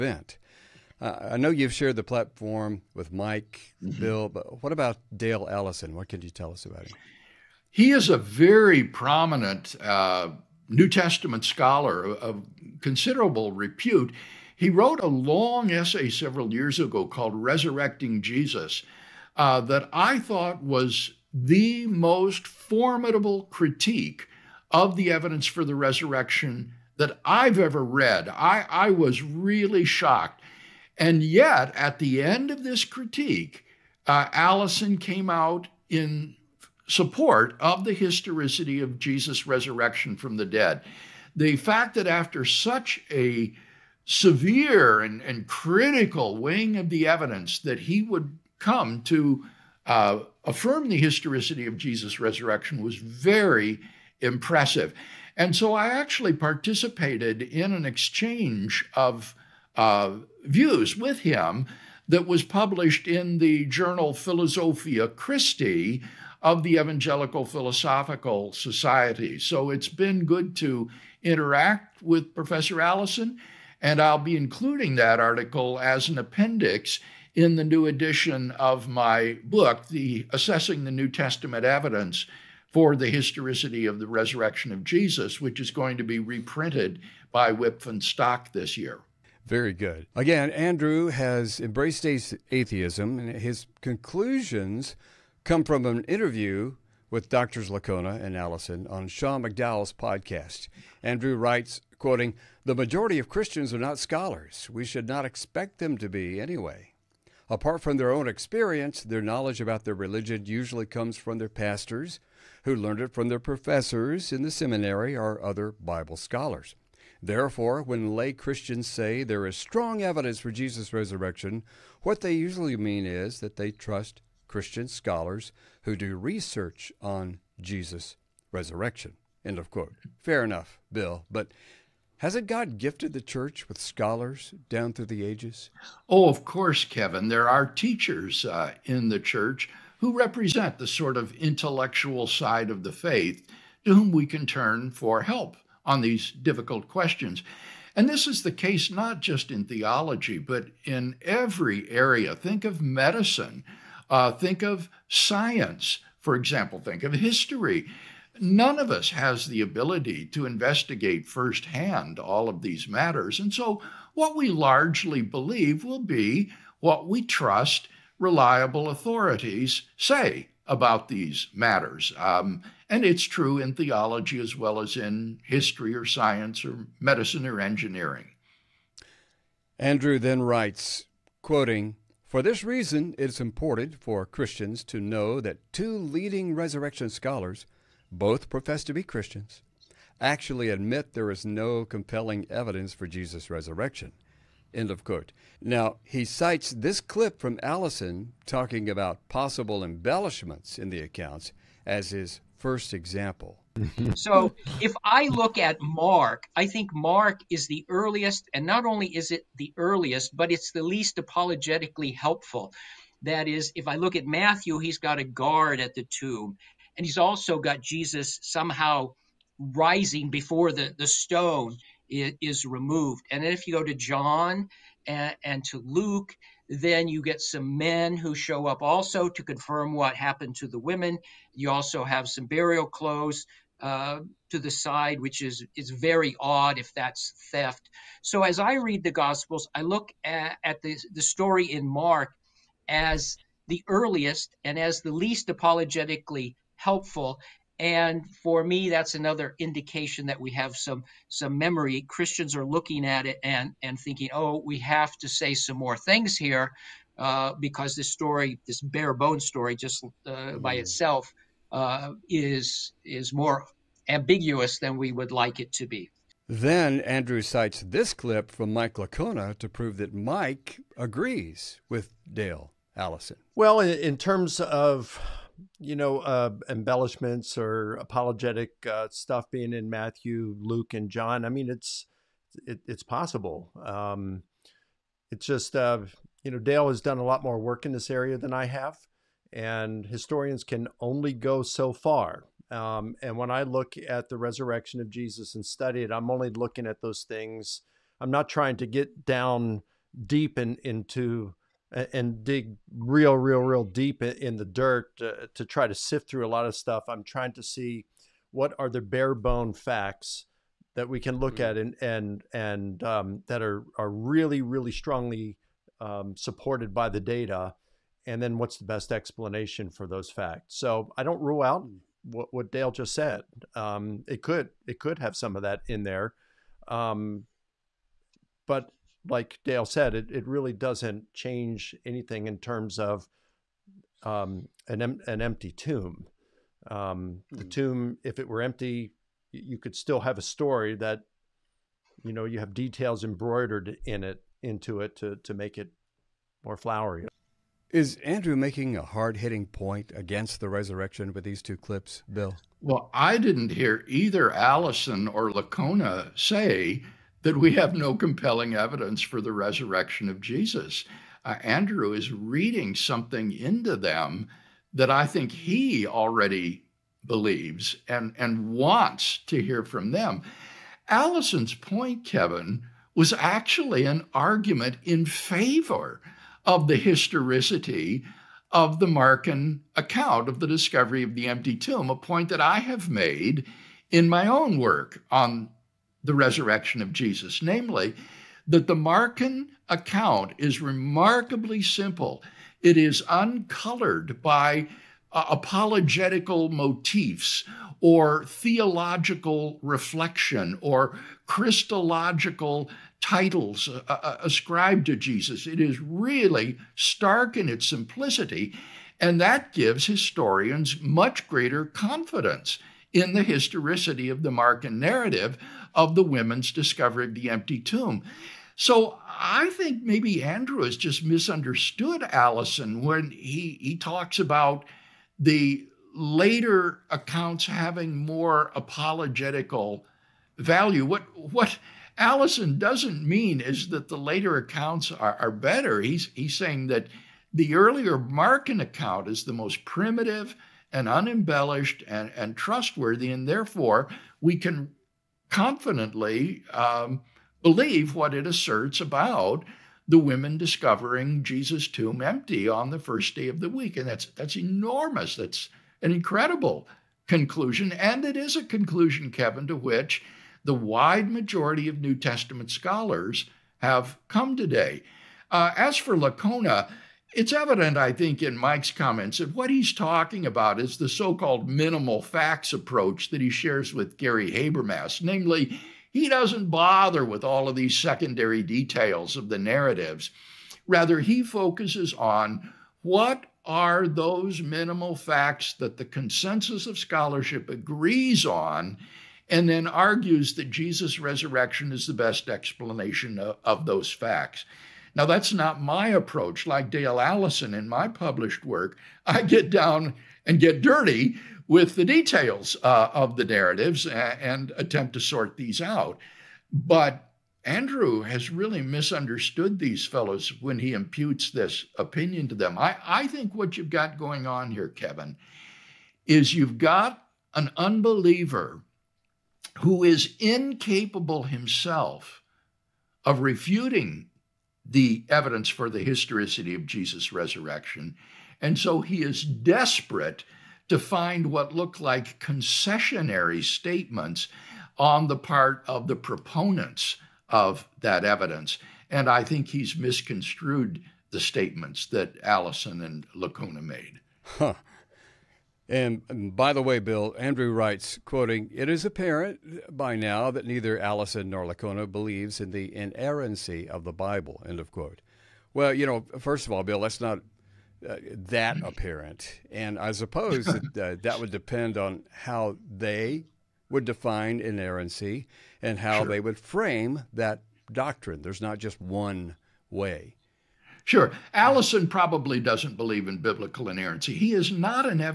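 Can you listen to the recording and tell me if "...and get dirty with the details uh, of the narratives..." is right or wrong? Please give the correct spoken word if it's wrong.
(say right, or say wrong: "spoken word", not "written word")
right.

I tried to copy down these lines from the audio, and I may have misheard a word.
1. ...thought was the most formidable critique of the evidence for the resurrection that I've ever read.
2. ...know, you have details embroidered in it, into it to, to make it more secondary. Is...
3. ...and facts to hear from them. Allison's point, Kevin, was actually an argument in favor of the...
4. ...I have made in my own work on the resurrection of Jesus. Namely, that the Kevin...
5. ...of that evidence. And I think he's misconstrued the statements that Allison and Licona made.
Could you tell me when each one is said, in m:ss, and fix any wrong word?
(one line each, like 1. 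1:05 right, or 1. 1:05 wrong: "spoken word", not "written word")
1. 0:20 right
2. 5:42 wrong: "flowery", not "secondary"
3. 6:08 wrong: "wants", not "facts"
4. 6:22 wrong: "Markan", not "Kevin"
5. 8:57 right.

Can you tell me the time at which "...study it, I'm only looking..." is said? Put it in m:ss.
4:55.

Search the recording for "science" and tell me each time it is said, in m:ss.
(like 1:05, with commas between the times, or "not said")
2:35, 2:56.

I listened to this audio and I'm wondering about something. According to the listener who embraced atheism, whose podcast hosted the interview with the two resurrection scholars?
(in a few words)
Sean McDowell.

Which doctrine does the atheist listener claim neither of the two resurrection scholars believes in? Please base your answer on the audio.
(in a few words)
Inerrancy of the Bible.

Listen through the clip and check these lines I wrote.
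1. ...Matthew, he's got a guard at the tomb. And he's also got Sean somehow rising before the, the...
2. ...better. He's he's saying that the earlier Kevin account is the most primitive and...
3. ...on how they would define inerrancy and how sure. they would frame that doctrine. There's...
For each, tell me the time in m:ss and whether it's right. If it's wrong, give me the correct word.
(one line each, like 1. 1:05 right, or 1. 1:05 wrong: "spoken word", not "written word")
1. 3:34 wrong: "Jesus", not "Sean"
2. 7:15 wrong: "Markan", not "Kevin"
3. 9:21 right.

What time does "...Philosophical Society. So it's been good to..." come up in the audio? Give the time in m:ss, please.
1:07.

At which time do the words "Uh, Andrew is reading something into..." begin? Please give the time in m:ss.
6:01.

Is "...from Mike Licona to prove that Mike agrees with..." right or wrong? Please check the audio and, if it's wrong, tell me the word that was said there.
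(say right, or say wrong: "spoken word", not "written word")
right.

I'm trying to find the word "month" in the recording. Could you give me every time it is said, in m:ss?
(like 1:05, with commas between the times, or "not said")
not said.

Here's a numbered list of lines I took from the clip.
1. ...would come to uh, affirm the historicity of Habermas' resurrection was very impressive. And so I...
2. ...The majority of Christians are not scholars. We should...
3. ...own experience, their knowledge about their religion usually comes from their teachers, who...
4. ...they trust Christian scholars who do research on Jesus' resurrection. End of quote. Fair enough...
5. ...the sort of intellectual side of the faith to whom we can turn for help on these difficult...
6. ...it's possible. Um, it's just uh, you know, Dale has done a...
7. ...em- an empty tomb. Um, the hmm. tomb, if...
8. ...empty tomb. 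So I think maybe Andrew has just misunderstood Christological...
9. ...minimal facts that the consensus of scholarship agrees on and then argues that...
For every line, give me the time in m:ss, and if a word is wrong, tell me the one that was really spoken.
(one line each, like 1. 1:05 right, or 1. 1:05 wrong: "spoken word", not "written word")
1. 0:48 wrong: "Jesus", not "Habermas"
2. 1:42 right
3. 1:48 wrong: "pastors", not "teachers"
4. 2:03 right
5. 2:20 right
6. 4:42 right
7. 5:35 right
8. 6:57 wrong: "Allison", not "Christological"
9. 8:04 right.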